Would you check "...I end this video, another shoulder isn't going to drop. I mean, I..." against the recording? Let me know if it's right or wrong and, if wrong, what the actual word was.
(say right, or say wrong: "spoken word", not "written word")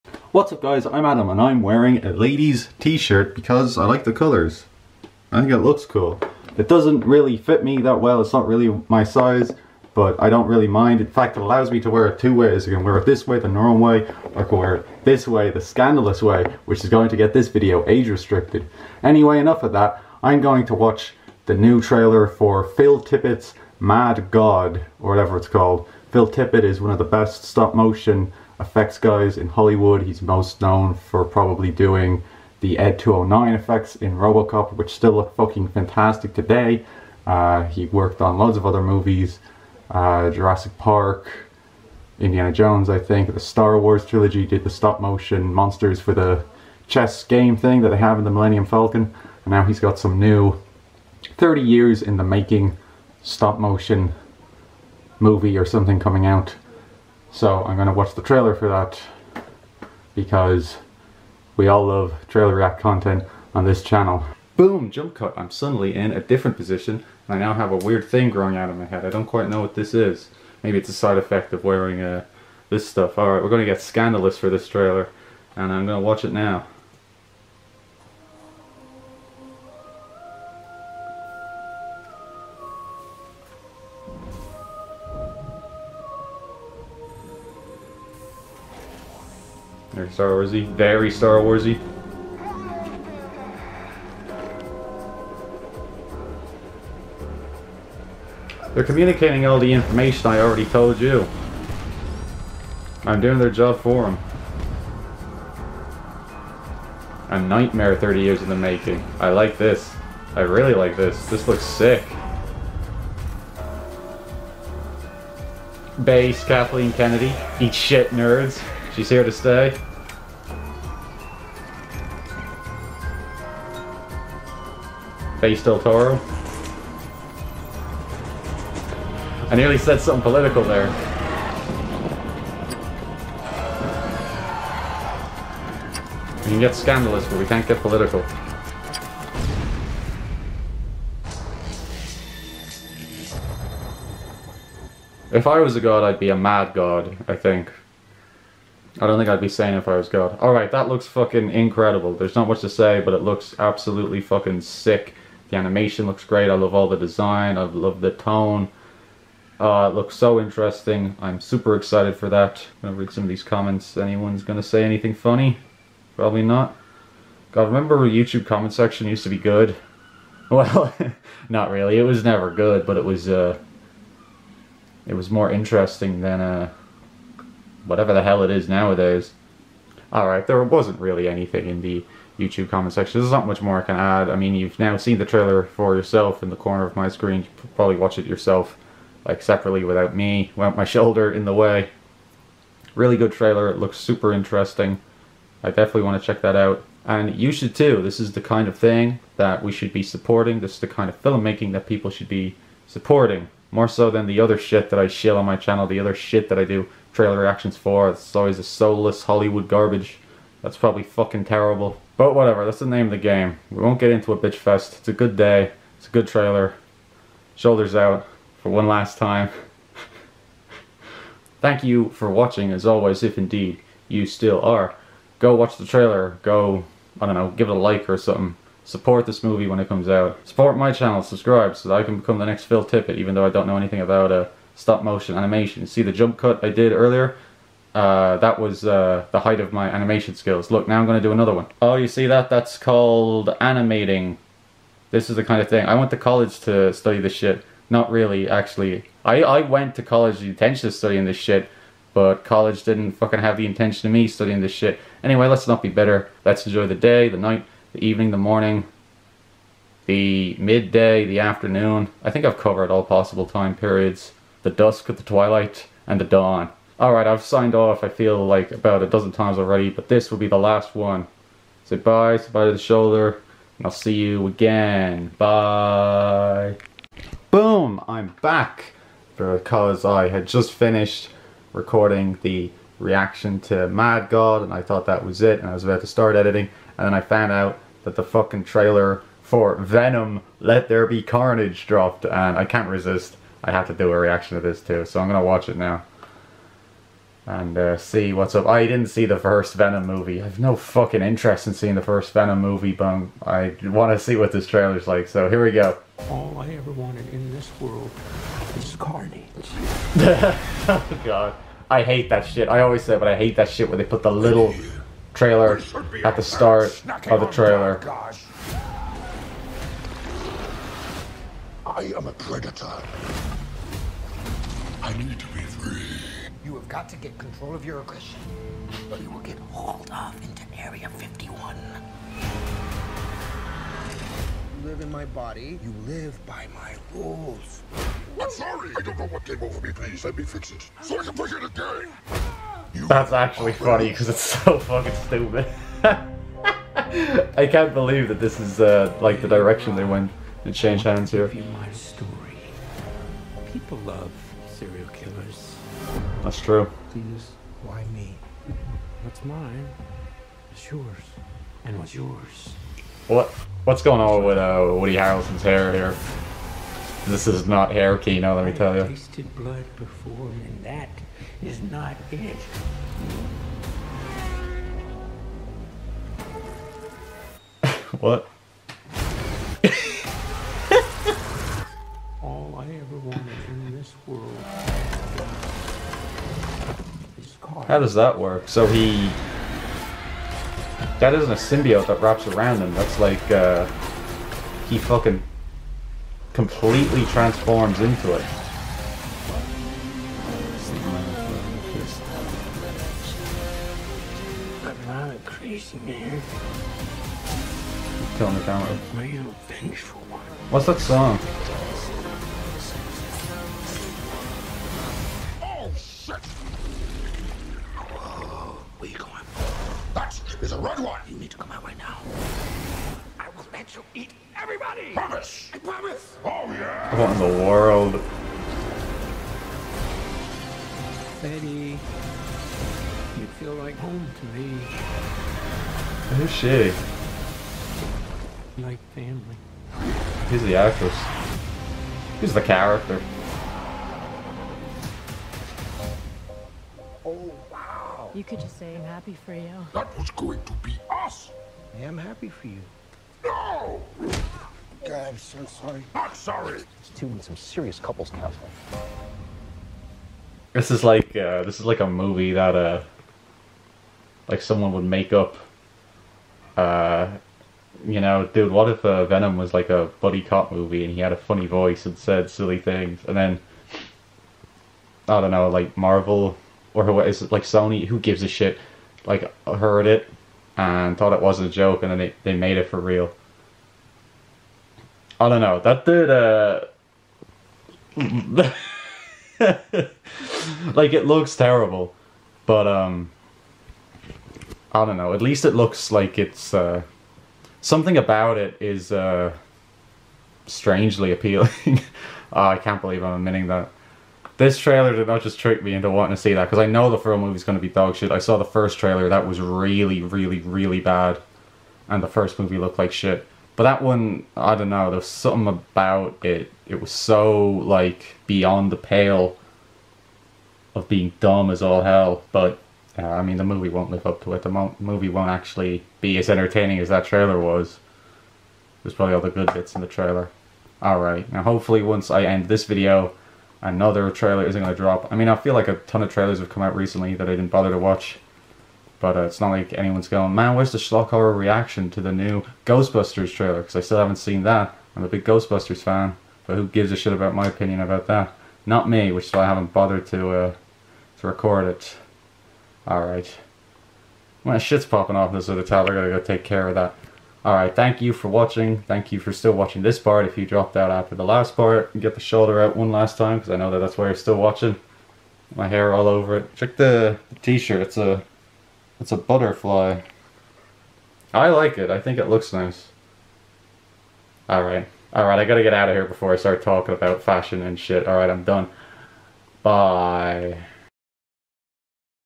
wrong: "trailer", not "shoulder".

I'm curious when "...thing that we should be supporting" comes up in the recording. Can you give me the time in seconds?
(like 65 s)
198 s.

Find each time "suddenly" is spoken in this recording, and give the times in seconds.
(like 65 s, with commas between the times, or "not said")
65 s.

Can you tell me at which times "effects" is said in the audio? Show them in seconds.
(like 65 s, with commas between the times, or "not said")
28 s, 33 s, 71 s.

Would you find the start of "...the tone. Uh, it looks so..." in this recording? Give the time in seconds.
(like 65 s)
158 s.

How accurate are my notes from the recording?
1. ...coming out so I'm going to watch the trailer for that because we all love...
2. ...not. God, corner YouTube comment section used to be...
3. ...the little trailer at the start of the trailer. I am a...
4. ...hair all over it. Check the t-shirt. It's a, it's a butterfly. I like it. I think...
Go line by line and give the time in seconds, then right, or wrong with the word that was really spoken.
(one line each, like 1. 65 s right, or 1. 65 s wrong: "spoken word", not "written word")
1. 55 s right
2. 166 s wrong: "remember", not "corner"
3. 314 s right
4. 565 s right.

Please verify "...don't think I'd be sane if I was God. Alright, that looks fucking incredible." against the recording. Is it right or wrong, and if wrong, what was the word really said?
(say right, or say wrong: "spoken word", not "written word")
right.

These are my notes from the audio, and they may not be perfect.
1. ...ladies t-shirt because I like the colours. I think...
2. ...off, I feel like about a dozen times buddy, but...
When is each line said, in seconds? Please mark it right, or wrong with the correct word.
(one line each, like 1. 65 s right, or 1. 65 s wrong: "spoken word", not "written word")
1. 2 s right
2. 267 s wrong: "already", not "buddy".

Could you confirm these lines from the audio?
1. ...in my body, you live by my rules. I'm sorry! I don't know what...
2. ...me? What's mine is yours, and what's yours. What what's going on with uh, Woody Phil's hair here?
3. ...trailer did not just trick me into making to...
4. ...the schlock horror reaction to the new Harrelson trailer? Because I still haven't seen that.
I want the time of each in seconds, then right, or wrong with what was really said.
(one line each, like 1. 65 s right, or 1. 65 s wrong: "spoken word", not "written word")
1. 335 s right
2. 358 s wrong: "Harrelson", not "Phil"
3. 504 s wrong: "wanting", not "making"
4. 540 s wrong: "Ghostbusters", not "Harrelson".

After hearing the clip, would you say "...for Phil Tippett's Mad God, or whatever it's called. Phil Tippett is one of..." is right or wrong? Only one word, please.
right.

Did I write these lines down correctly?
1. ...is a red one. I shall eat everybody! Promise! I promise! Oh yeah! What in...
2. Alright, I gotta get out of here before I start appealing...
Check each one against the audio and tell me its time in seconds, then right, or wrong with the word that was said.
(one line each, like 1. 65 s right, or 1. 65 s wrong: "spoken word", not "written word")
1. 420 s right
2. 575 s wrong: "talking", not "appealing".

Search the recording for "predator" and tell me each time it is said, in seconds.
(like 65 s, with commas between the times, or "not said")
322 s.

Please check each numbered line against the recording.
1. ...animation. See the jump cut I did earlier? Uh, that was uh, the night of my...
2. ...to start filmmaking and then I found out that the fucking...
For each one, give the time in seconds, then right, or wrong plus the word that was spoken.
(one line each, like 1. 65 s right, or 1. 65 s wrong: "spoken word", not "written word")
1. 235 s wrong: "height", not "night"
2. 286 s wrong: "editing", not "filmmaking".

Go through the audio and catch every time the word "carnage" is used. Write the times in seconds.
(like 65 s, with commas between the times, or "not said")
291 s, 308 s.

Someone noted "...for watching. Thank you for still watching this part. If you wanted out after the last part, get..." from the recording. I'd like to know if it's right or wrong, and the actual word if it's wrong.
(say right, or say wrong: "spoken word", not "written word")
wrong: "dropped", not "wanted".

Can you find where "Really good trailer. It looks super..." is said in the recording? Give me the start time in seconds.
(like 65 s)
192 s.